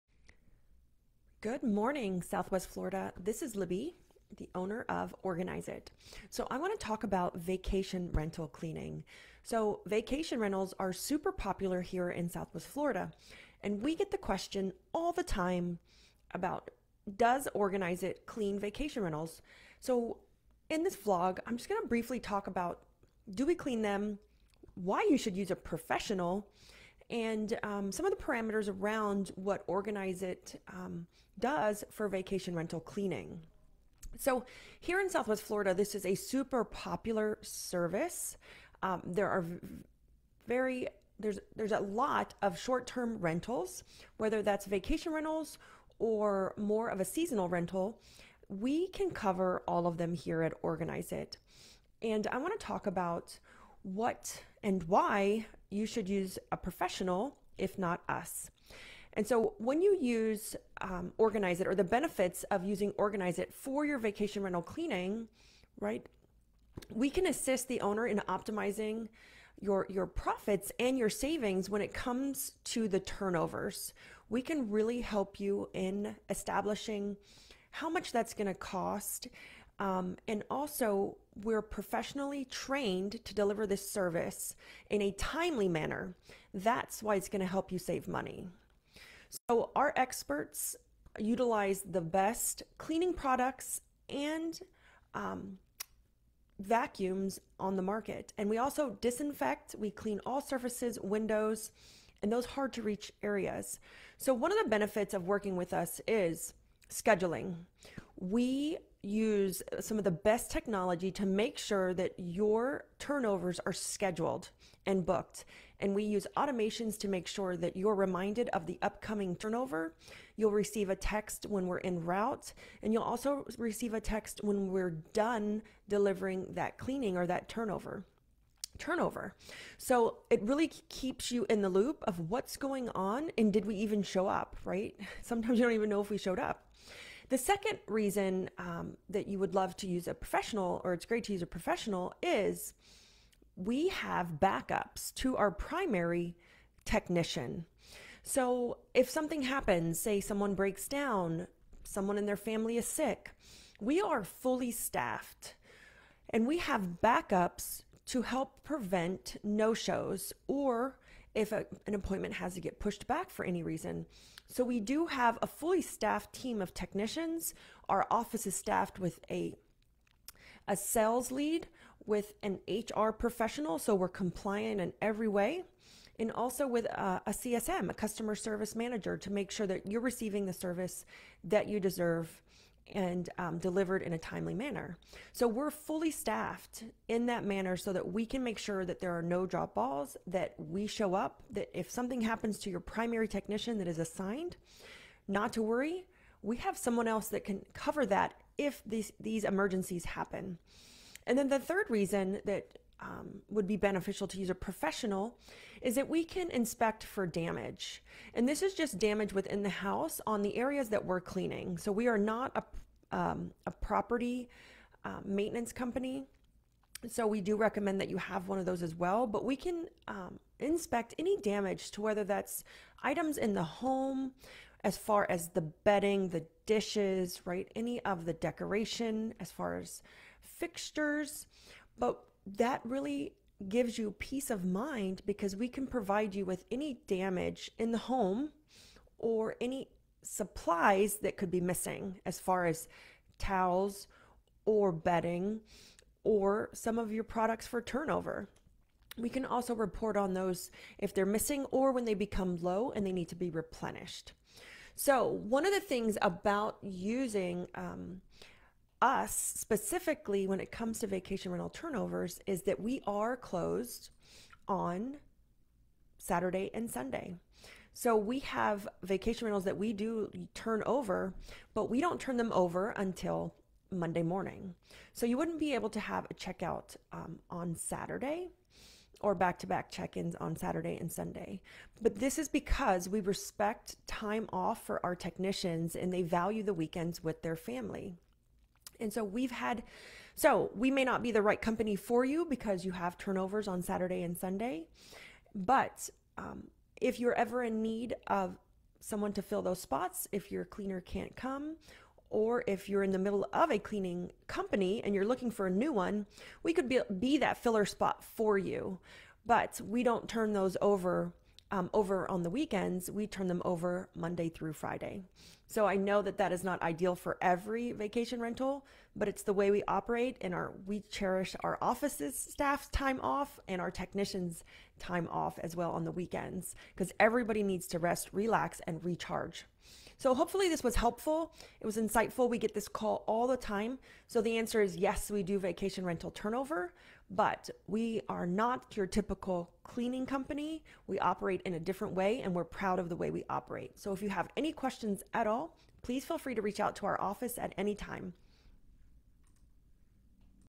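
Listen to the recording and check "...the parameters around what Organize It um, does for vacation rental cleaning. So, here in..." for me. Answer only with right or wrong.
right.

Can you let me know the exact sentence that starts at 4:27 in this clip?
So we have vacation rentals that we do turn over, but we don't turn them over until Monday morning.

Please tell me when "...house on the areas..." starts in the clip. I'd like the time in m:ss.
3:29.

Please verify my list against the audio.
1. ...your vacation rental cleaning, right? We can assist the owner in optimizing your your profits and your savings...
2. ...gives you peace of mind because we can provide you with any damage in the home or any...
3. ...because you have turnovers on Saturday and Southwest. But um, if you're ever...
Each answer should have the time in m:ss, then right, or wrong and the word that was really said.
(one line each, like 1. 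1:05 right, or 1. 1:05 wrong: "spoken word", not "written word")
1. 1:03 right
2. 3:53 right
3. 4:52 wrong: "Sunday", not "Southwest".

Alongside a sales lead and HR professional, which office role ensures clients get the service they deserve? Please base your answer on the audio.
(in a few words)
customer service manager.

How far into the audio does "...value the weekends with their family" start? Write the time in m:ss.
4:46.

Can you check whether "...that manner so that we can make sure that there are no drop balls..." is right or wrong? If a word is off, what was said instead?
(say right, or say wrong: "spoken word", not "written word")
right.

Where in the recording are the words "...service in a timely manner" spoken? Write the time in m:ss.
1:23.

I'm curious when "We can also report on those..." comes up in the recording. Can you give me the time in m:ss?
4:09.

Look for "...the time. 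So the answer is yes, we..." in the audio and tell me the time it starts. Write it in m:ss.
5:33.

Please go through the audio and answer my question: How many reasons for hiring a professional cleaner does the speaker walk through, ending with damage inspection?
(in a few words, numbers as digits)
3.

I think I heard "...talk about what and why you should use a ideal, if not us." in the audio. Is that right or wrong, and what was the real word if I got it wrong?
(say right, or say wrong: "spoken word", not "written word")
wrong: "professional", not "ideal".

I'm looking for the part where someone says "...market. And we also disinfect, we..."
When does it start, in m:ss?
1:37.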